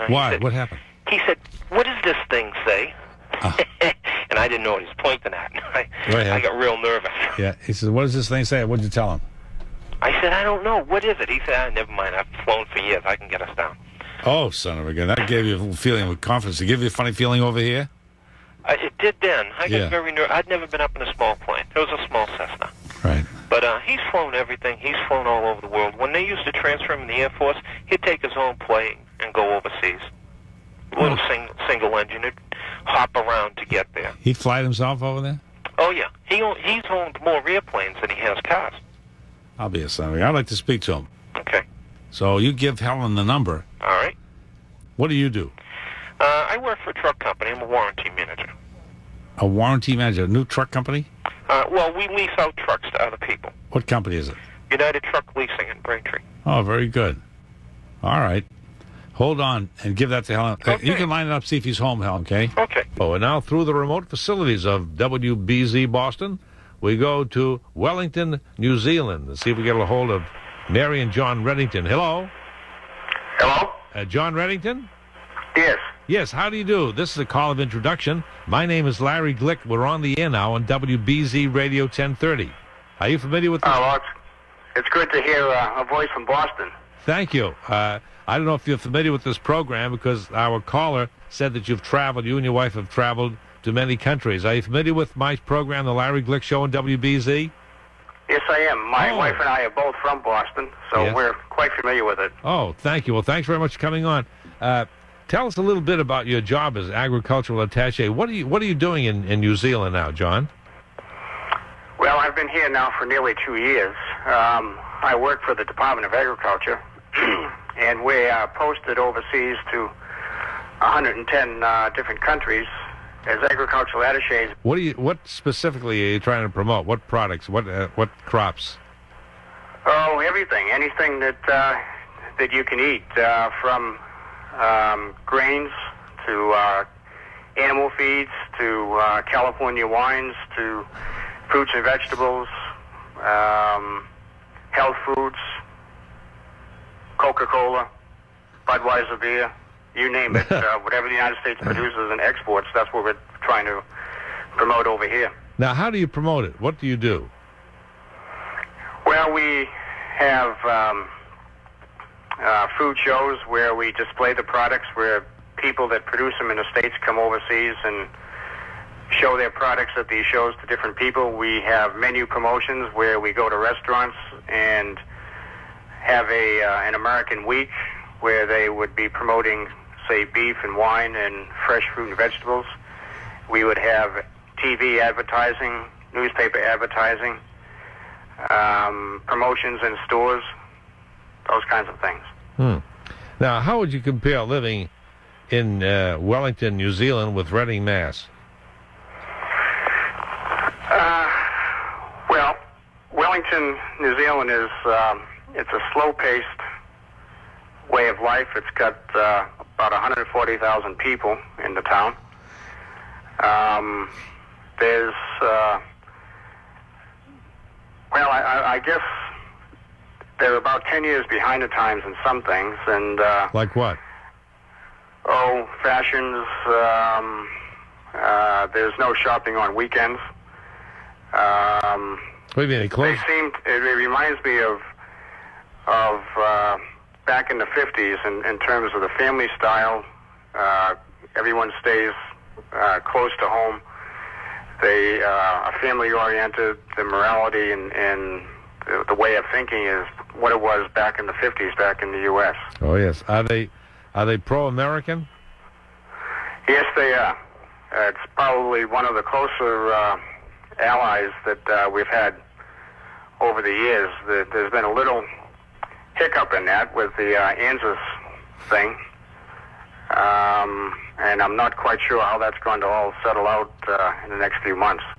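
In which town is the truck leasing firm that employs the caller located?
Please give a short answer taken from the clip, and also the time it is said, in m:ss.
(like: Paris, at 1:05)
Braintree, at 0:55.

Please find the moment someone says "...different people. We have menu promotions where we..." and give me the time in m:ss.
2:50.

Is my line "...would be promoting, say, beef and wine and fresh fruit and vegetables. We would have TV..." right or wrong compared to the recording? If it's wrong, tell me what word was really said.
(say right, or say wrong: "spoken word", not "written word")
right.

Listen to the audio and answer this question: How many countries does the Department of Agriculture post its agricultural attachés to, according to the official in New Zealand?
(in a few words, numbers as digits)
110.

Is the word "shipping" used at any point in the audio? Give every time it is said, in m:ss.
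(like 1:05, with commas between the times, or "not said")
not said.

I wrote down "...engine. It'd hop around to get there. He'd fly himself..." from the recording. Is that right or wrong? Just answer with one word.
right.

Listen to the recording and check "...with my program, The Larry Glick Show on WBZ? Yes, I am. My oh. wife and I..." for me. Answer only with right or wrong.
right.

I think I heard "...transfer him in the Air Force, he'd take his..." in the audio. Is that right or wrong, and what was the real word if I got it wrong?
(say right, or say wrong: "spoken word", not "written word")
right.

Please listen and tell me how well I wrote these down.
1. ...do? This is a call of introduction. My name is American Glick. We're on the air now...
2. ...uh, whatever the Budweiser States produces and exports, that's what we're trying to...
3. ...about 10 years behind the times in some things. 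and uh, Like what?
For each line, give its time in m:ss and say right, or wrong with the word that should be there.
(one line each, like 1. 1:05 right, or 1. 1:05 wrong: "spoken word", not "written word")
1. 1:16 wrong: "Larry", not "American"
2. 2:30 wrong: "United", not "Budweiser"
3. 3:40 right.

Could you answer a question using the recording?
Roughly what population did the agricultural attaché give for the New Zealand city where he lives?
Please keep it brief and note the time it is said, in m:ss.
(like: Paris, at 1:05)
140,000, at 3:29.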